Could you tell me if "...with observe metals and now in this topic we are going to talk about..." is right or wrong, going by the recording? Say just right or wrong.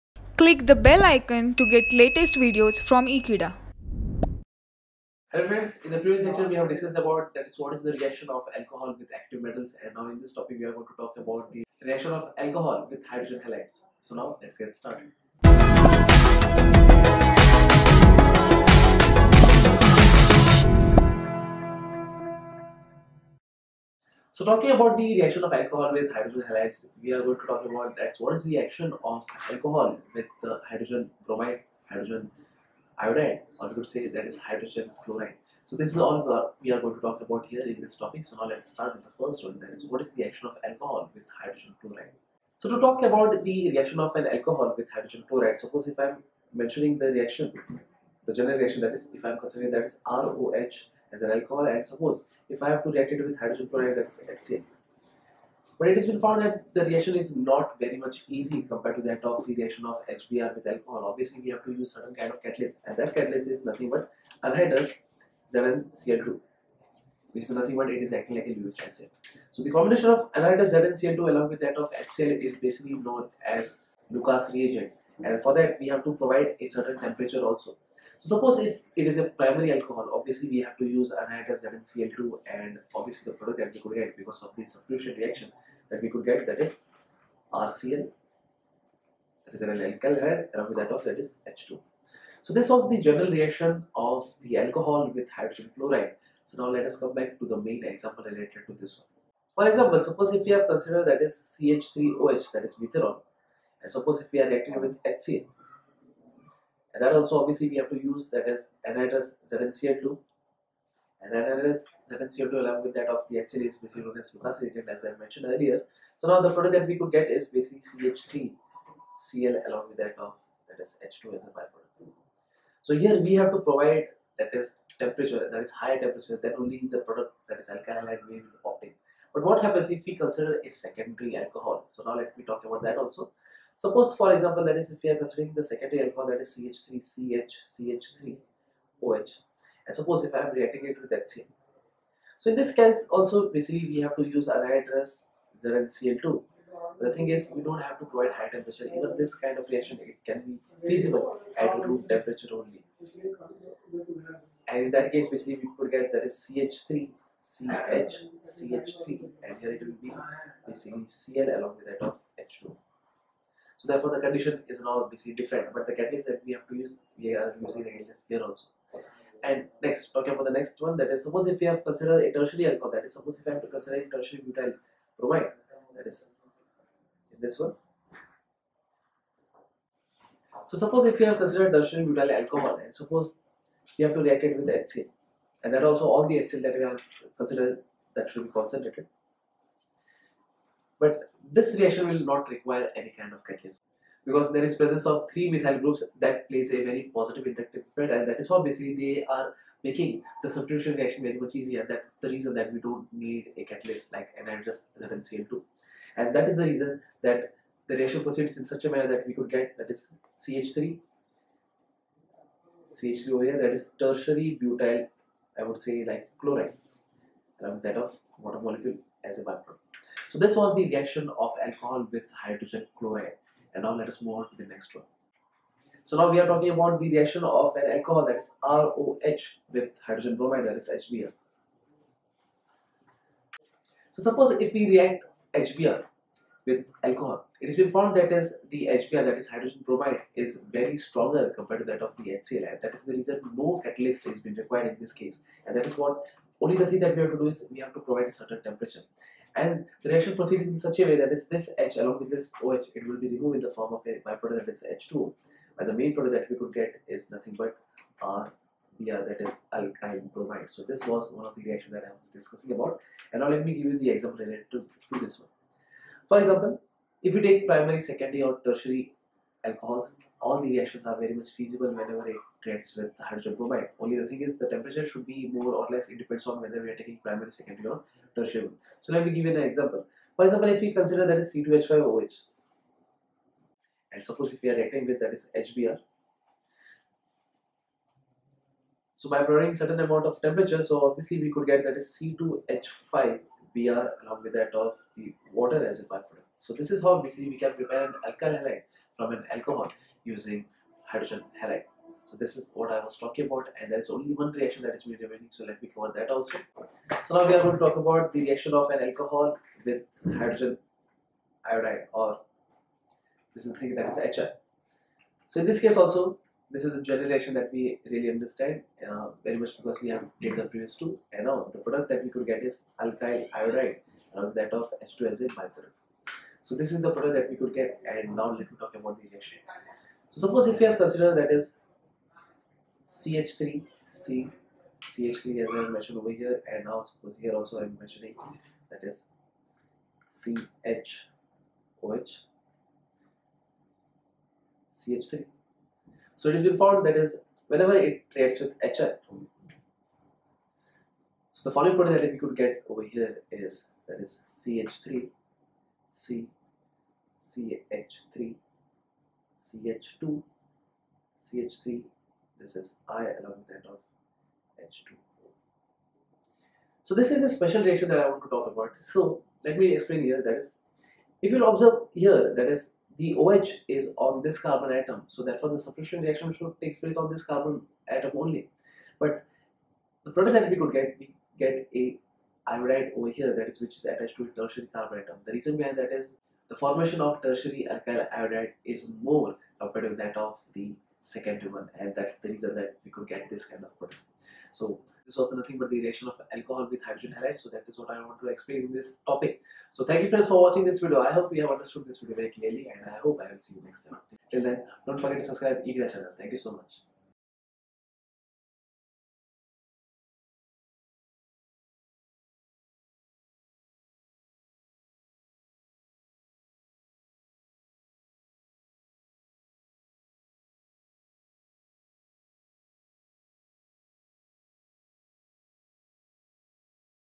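wrong.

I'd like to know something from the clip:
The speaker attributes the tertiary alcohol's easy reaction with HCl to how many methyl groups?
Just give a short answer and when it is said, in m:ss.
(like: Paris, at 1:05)
3, at 3:15.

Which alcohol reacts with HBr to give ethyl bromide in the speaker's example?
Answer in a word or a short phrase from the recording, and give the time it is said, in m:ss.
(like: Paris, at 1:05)
C2H5OH, at 4:41.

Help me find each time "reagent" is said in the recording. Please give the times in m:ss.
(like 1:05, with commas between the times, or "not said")
1:14, 1:54.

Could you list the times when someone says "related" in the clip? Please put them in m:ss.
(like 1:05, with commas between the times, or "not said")
1:38, 4:24.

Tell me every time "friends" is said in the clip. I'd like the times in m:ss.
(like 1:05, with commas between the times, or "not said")
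0:05, 6:40.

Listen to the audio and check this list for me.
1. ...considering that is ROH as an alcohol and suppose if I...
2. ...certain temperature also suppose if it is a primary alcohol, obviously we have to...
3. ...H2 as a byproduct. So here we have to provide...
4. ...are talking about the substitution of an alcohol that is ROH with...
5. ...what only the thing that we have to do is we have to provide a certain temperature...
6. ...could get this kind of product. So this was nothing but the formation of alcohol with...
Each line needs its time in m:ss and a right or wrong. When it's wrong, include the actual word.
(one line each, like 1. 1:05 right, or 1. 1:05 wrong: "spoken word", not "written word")
1. 0:49 right
2. 1:16 right
3. 2:01 right
4. 3:46 wrong: "reaction", not "substitution"
5. 4:05 right
6. 6:33 wrong: "reaction", not "formation".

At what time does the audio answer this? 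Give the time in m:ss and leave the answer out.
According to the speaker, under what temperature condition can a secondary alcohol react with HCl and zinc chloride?
2:31.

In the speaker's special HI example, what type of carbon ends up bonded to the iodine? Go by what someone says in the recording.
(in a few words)
Tertiary carbon.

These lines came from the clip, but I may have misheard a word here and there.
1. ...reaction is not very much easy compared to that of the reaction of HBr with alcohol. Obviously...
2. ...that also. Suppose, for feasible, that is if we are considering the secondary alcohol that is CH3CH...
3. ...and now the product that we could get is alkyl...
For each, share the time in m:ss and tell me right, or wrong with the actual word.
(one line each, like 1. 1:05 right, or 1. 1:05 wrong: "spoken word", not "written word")
1. 0:56 right
2. 2:12 wrong: "example", not "feasible"
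3. 5:21 right.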